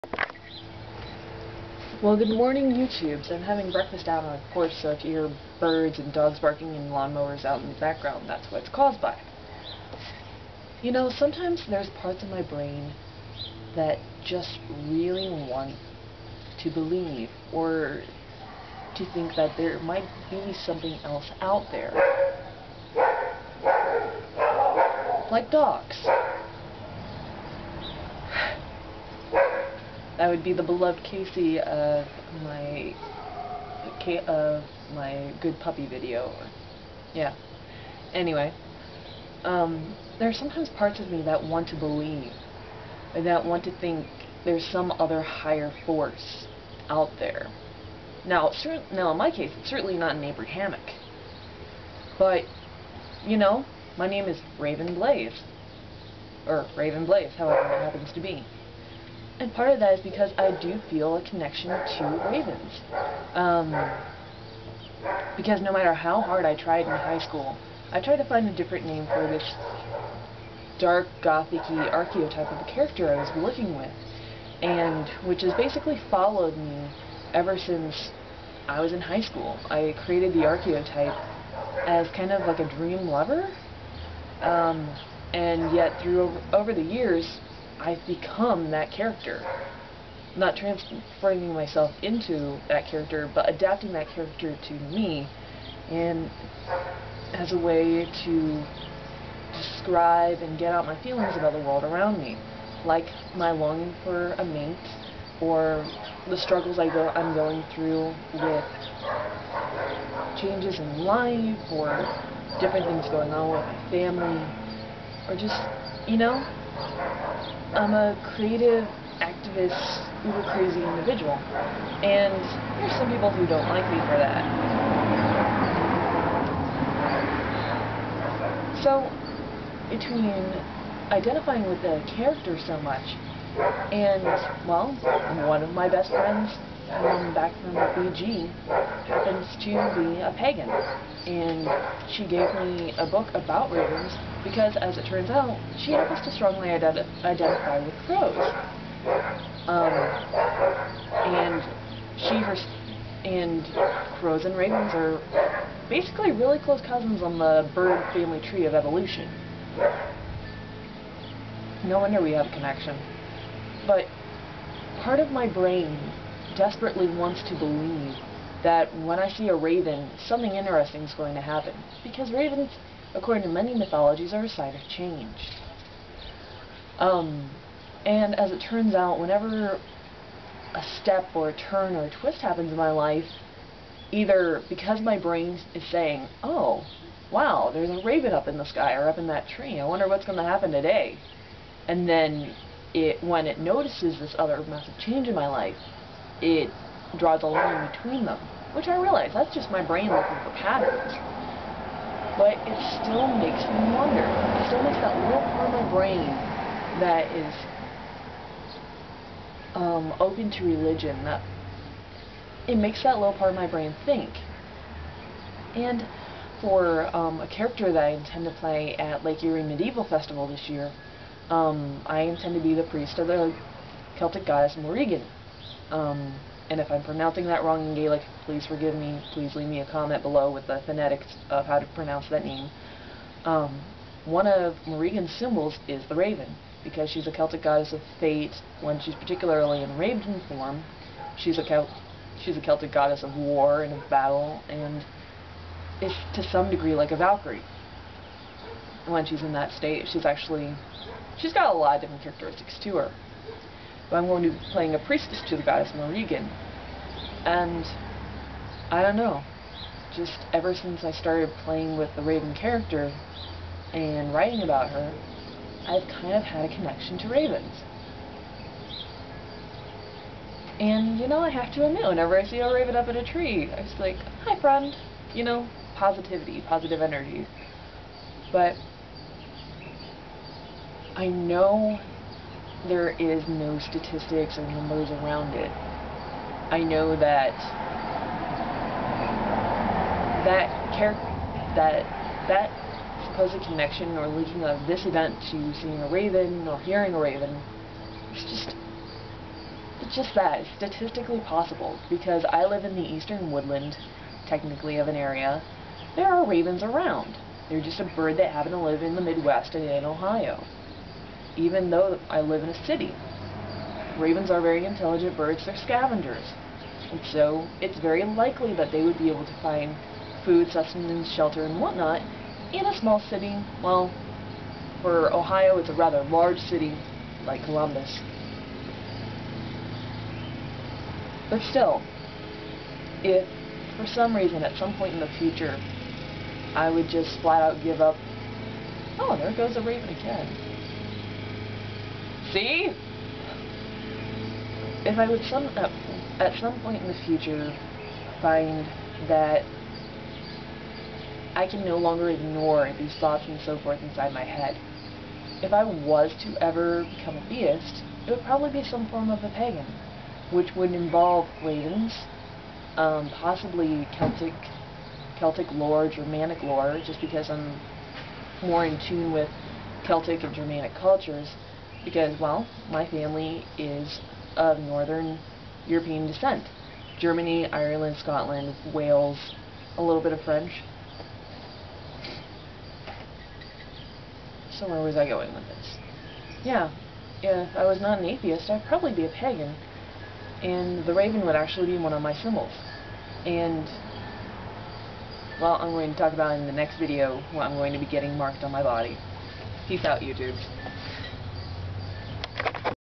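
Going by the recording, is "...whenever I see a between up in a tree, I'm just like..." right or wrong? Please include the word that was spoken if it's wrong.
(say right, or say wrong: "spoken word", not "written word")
wrong: "raven", not "between".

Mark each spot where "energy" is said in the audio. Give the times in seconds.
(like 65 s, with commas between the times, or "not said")
277 s.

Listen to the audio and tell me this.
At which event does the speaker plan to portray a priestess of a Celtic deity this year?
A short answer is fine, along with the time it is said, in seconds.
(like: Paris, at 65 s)
Lake Erie Medieval Festival, at 219 s.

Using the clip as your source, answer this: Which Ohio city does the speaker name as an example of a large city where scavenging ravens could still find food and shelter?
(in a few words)
Columbus.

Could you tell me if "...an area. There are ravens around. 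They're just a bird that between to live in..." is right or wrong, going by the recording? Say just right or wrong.
wrong.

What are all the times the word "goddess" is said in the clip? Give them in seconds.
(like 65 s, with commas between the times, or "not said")
224 s, 237 s, 242 s, 255 s.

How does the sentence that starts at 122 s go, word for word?
And there's some people who don't like me for that.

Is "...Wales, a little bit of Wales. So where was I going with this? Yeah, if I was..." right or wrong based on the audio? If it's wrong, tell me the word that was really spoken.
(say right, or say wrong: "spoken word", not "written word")
wrong: "French", not "Wales".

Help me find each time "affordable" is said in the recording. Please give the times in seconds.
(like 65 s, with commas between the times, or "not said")
not said.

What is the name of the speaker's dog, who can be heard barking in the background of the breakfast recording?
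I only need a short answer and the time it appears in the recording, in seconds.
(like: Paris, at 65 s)
Casey, at 31 s.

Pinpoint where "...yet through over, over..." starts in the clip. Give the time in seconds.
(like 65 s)
85 s.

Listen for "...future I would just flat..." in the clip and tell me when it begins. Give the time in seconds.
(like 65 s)
335 s.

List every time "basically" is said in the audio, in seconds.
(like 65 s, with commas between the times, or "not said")
75 s, 155 s.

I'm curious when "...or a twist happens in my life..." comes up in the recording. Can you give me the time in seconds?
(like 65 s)
181 s.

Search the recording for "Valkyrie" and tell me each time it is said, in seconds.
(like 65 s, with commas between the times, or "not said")
247 s.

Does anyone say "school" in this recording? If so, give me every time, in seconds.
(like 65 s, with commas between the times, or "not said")
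67 s, 79 s.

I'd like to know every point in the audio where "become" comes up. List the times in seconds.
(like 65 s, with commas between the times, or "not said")
88 s, 357 s.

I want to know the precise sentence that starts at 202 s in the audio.
But it still makes me wonder.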